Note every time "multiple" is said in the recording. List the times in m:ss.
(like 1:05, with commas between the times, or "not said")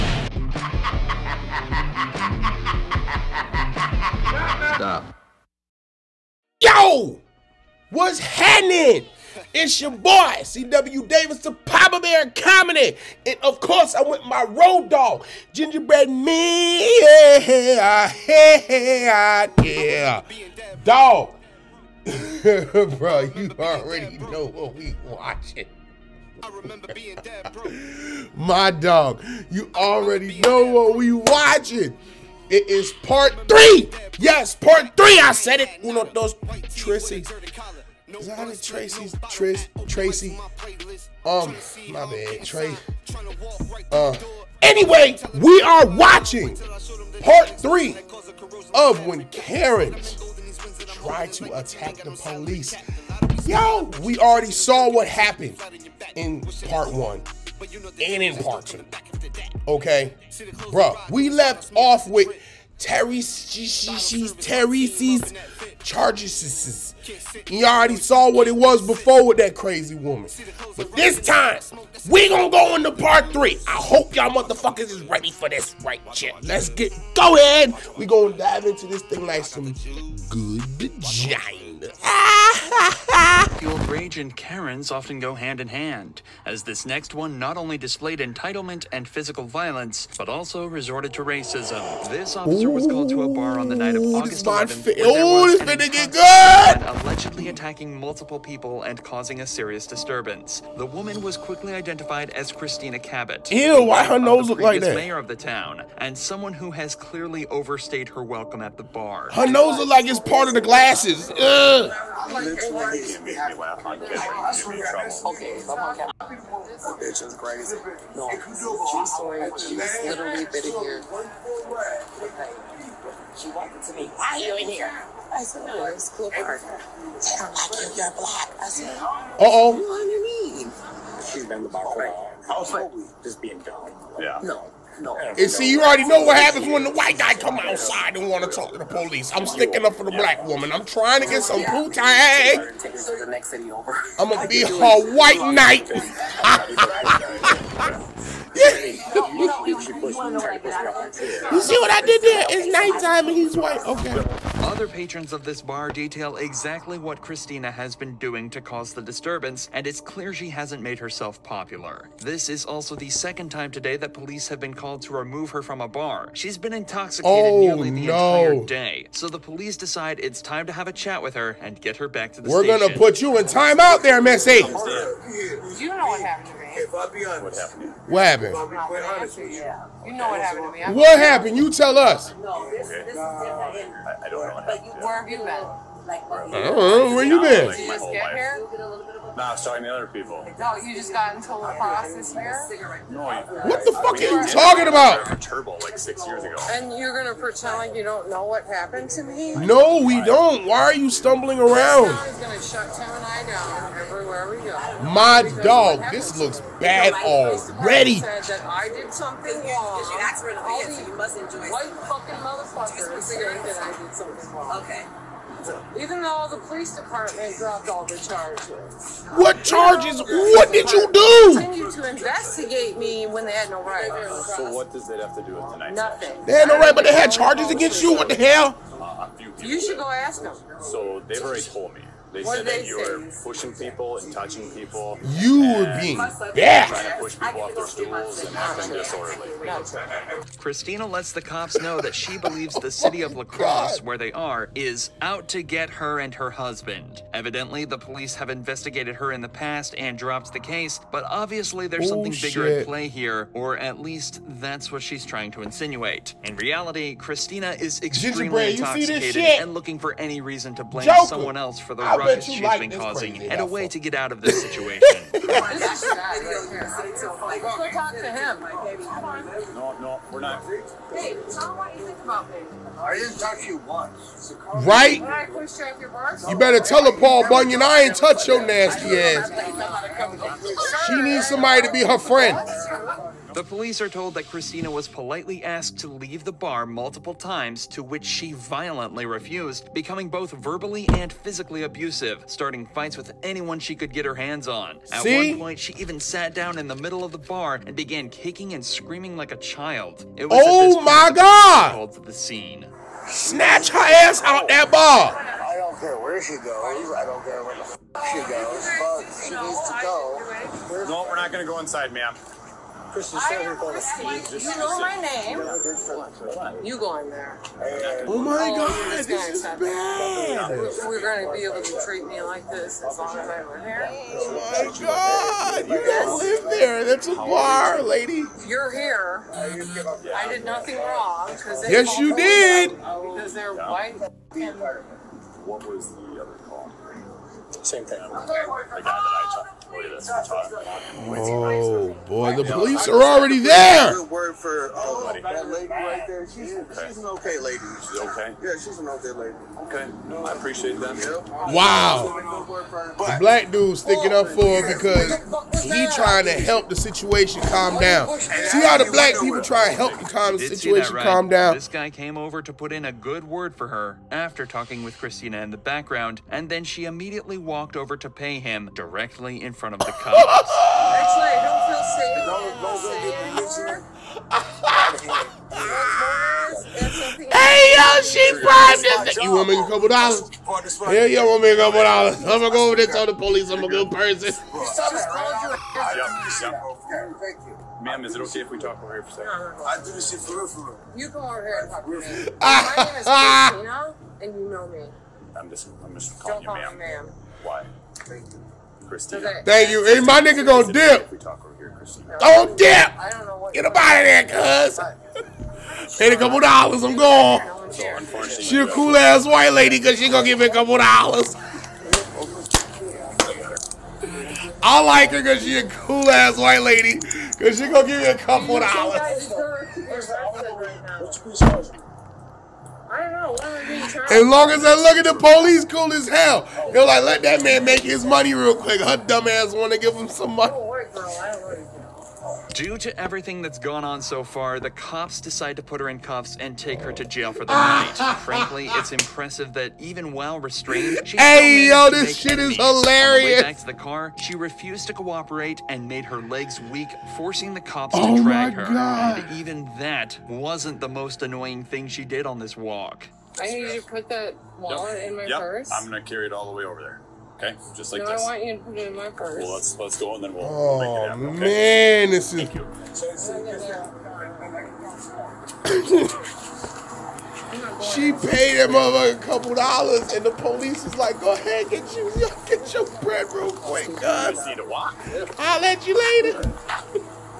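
1:37, 4:46.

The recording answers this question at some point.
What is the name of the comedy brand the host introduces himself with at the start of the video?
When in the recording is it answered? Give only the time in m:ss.
0:11.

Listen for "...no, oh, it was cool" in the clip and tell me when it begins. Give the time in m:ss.
2:05.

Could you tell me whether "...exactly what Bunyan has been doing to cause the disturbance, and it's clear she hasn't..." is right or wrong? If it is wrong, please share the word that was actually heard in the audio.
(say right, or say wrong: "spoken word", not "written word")
wrong: "Christina", not "Bunyan".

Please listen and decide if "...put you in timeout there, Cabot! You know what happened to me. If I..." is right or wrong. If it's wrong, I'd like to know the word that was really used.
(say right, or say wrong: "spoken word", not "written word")
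wrong: "Missy", not "Cabot".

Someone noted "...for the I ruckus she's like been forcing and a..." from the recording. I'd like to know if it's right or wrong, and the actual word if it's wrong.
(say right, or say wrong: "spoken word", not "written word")
wrong: "causing", not "forcing".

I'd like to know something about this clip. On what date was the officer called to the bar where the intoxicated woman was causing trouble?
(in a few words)
August 11th.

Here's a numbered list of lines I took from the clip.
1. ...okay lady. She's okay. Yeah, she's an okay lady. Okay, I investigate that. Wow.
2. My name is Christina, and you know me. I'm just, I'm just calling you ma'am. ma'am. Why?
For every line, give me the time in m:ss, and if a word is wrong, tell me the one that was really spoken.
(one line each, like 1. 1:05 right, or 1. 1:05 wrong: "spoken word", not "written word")
1. 5:47 wrong: "appreciate", not "investigate"
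2. 6:32 right.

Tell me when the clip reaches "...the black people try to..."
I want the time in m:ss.
5:58.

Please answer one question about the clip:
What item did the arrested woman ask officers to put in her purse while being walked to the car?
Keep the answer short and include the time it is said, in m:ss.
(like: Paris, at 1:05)
wallet, at 7:34.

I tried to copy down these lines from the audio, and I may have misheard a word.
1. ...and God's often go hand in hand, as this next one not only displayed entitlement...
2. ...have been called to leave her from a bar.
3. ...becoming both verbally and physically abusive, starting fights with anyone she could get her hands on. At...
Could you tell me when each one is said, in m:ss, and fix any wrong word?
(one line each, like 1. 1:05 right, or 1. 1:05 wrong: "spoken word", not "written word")
1. 1:24 wrong: "Karen", not "God"
2. 2:44 wrong: "remove", not "leave"
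3. 4:49 right.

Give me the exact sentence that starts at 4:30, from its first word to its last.
you I didn't touch you Right?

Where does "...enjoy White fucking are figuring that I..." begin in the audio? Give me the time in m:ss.
3:31.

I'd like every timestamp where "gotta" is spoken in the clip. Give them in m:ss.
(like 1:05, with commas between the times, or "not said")
5:26.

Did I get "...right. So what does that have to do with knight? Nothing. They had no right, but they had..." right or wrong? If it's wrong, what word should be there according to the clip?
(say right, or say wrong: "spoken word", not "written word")
wrong: "tonight", not "knight".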